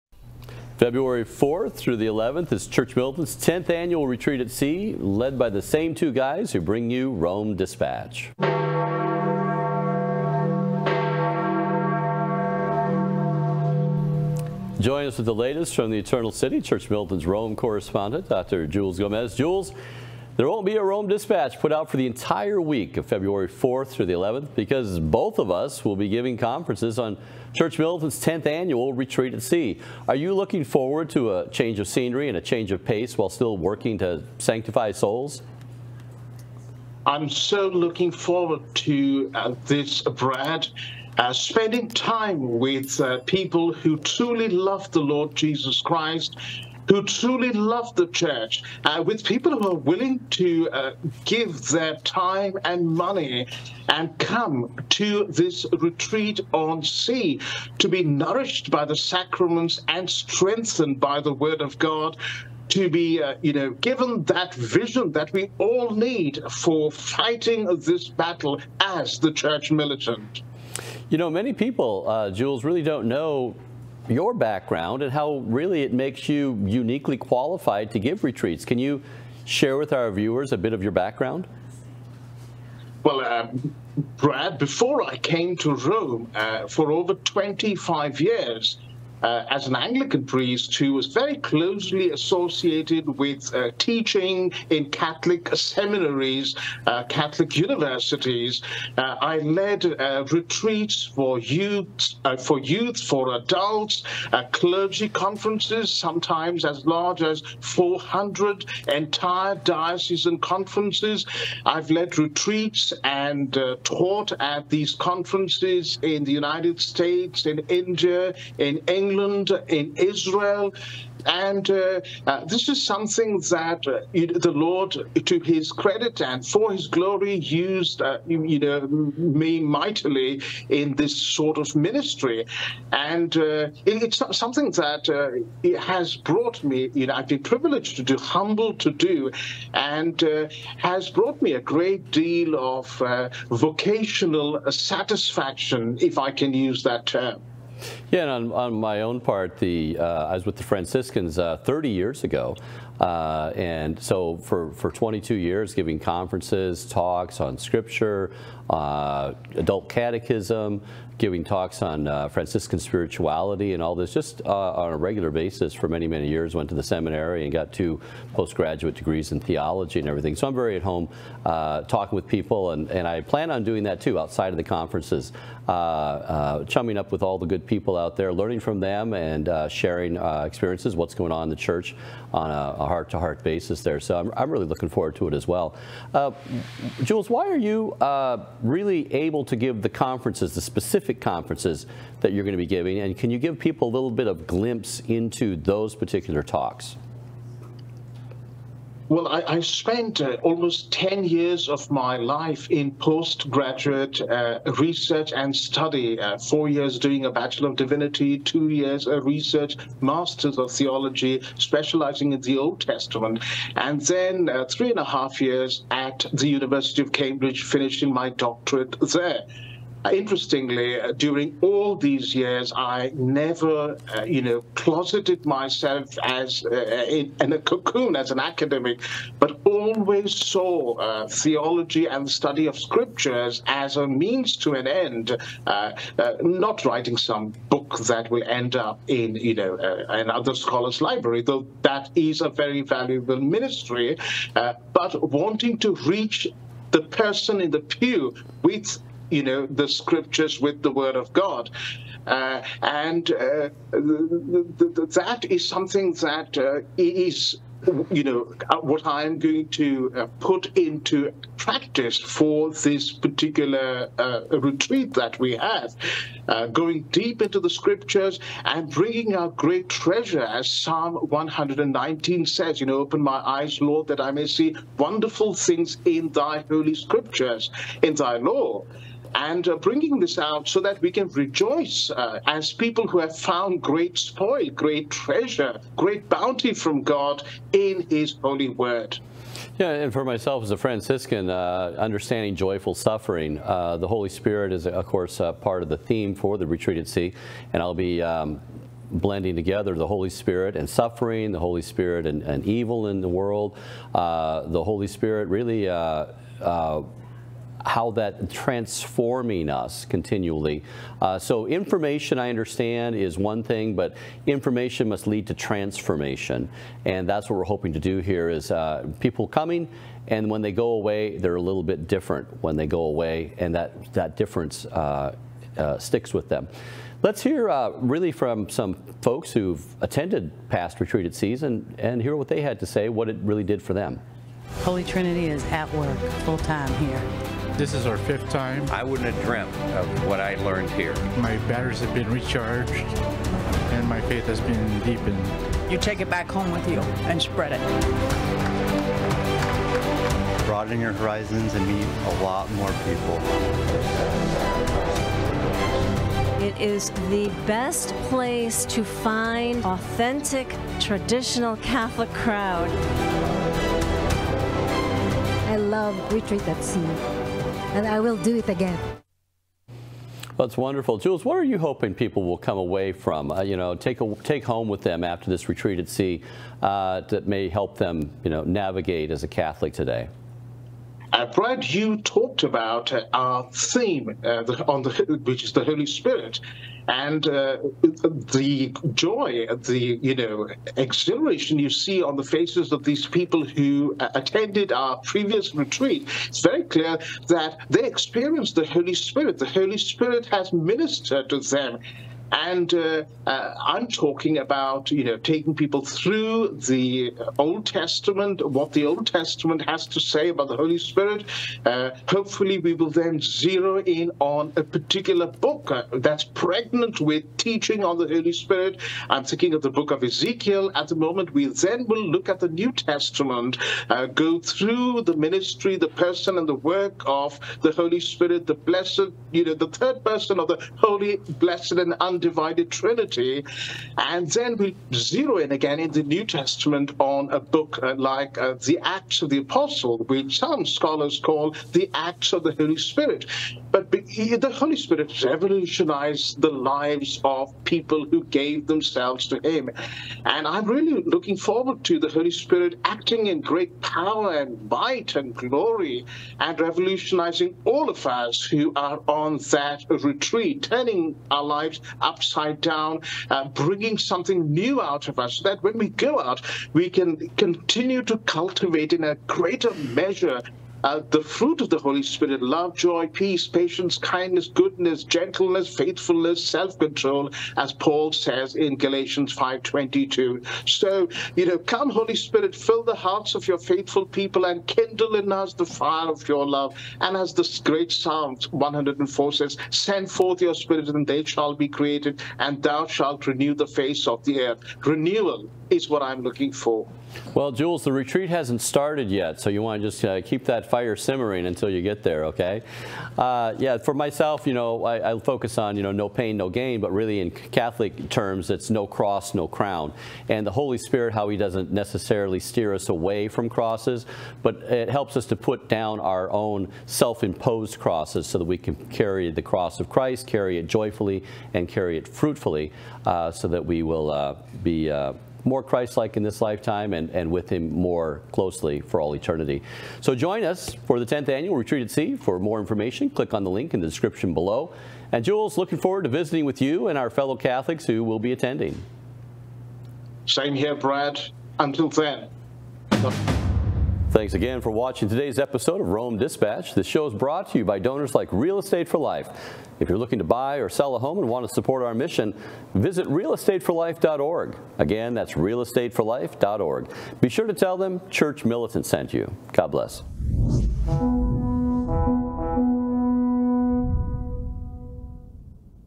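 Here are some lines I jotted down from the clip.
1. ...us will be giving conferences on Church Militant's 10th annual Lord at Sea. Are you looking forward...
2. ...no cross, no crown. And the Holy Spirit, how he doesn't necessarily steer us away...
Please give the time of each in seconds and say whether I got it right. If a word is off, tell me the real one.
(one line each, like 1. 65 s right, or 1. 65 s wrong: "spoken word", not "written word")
1. 25 s wrong: "Retreat", not "Lord"
2. 508 s right.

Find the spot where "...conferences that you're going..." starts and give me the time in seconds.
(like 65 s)
191 s.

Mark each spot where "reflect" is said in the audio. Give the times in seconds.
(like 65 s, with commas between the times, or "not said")
not said.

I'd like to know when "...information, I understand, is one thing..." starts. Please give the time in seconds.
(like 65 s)
311 s.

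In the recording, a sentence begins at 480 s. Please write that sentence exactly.
So, you know, come, Holy Spirit, fill the hearts of your faithful people and kindle in us the fire of your love.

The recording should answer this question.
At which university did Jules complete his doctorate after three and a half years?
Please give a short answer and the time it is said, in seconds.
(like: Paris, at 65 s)
University of Cambridge, at 216 s.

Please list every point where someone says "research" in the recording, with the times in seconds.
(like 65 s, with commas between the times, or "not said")
204 s, 209 s.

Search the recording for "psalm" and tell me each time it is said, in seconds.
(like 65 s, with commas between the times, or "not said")
270 s, 488 s.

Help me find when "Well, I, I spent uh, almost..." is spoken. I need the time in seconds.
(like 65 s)
199 s.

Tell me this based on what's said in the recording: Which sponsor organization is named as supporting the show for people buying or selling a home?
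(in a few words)
Real Estate for Life.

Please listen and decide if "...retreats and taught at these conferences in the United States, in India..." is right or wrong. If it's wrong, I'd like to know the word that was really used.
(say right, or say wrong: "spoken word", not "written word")
right.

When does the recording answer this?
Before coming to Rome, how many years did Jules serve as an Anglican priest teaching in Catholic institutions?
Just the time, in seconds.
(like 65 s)
87 s.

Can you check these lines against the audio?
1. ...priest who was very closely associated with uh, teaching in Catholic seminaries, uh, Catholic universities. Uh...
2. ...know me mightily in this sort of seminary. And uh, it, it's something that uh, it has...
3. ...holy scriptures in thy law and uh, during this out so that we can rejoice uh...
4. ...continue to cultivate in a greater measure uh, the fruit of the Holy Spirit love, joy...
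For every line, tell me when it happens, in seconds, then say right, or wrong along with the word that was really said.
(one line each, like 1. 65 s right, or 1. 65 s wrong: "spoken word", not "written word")
1. 90 s right
2. 128 s wrong: "ministry", not "seminary"
3. 276 s wrong: "bringing", not "during"
4. 467 s right.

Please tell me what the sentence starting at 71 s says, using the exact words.
You know, many people, uh, Jules, really don't know your background and how really it makes you uniquely qualified to give retreats.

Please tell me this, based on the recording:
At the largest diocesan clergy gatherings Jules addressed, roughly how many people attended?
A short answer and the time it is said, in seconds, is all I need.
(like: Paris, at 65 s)
400, at 107 s.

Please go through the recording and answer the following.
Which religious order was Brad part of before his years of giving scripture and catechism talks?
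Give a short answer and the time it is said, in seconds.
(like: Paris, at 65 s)
Franciscans, at 150 s.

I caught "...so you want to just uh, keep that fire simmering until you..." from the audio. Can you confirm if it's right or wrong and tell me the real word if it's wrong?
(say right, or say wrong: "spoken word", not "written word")
right.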